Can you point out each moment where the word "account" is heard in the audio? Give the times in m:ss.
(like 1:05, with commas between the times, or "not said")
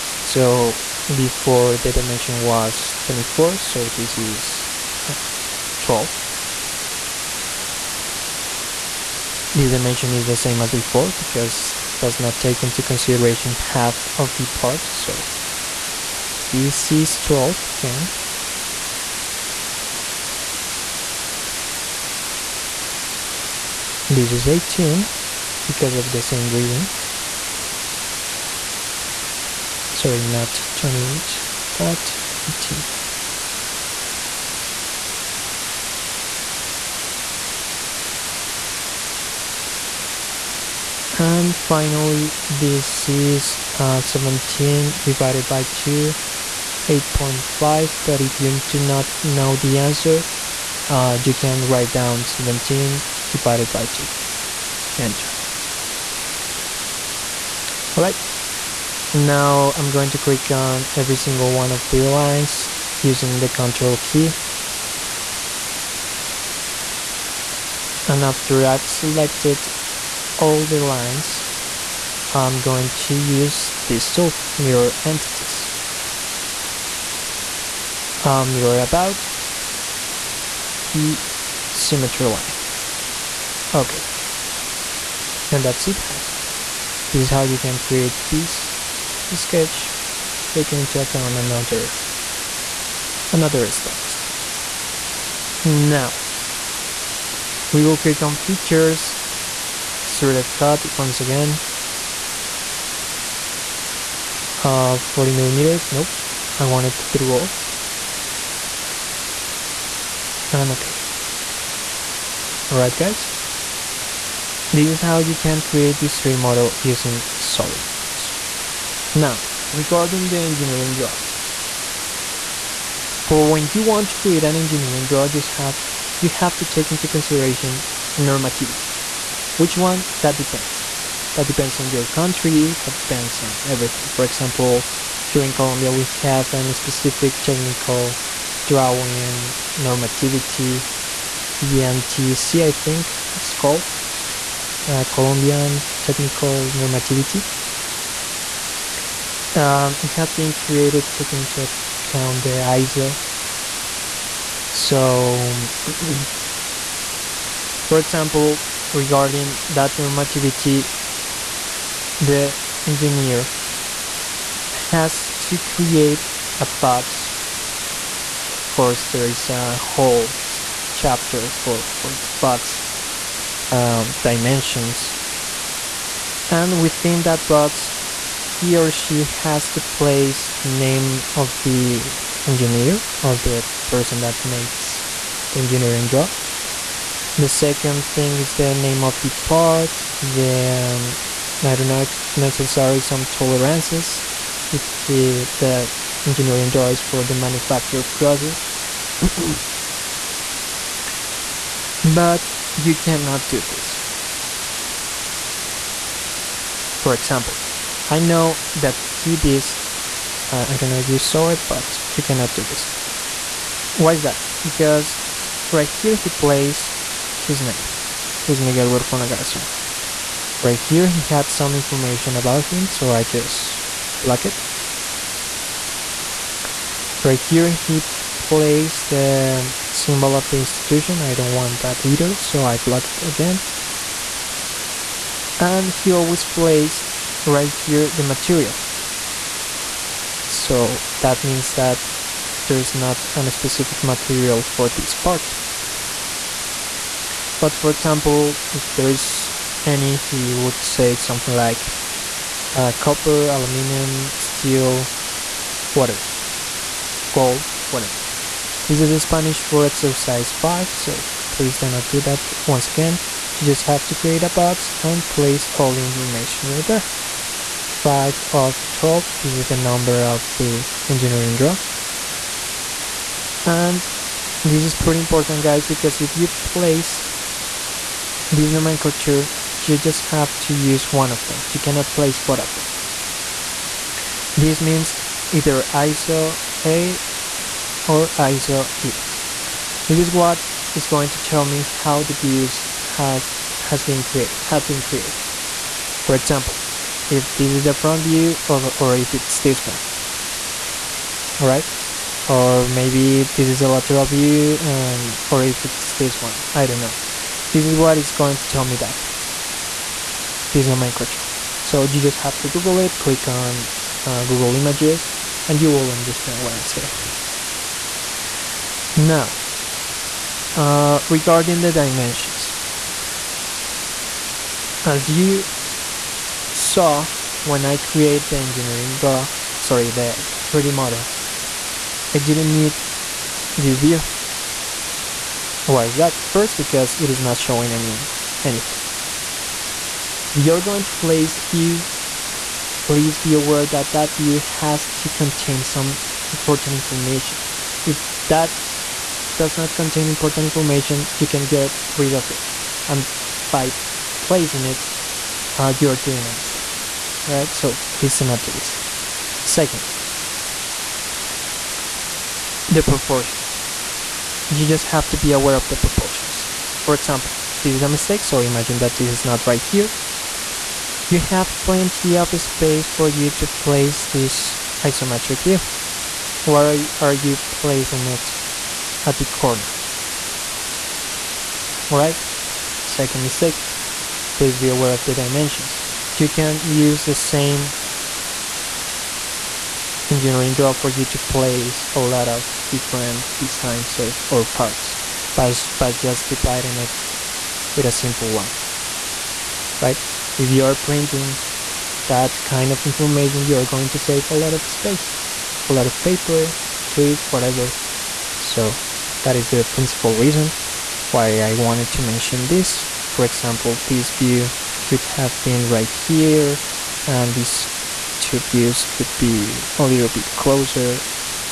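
1:31, 2:31.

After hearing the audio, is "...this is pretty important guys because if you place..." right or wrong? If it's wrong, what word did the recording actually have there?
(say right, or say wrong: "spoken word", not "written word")
right.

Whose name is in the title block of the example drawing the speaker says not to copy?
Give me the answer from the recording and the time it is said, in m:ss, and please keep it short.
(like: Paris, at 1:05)
Miguel Huerfona Garzon, at 3:38.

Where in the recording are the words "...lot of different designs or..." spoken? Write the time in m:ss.
6:32.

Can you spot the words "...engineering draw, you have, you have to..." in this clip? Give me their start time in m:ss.
2:04.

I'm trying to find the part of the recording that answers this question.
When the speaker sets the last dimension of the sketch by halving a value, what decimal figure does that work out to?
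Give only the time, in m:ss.
0:46.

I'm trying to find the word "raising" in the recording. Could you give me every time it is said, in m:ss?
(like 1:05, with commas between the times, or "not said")
not said.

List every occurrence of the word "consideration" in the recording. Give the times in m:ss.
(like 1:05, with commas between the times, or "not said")
0:12, 2:07.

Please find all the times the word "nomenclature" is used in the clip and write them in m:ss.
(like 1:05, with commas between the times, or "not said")
4:38, 5:10.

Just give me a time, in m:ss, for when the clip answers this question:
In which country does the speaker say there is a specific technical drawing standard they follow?
2:15.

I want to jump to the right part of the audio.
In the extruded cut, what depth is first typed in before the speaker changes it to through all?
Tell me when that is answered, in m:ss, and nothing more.
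1:44.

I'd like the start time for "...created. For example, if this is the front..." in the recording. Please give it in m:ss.
4:55.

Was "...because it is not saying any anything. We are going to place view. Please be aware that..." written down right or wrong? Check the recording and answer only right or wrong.
wrong.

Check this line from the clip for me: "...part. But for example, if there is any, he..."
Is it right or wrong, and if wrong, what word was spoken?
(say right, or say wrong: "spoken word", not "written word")
right.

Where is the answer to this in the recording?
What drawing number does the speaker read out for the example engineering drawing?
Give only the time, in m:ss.
4:28.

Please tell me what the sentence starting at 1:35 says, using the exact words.
Now we will click on features extruded cut once again.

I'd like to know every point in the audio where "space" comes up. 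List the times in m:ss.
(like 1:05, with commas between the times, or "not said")
6:12, 6:44.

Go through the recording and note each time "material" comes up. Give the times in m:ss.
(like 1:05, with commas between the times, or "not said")
3:58, 4:04.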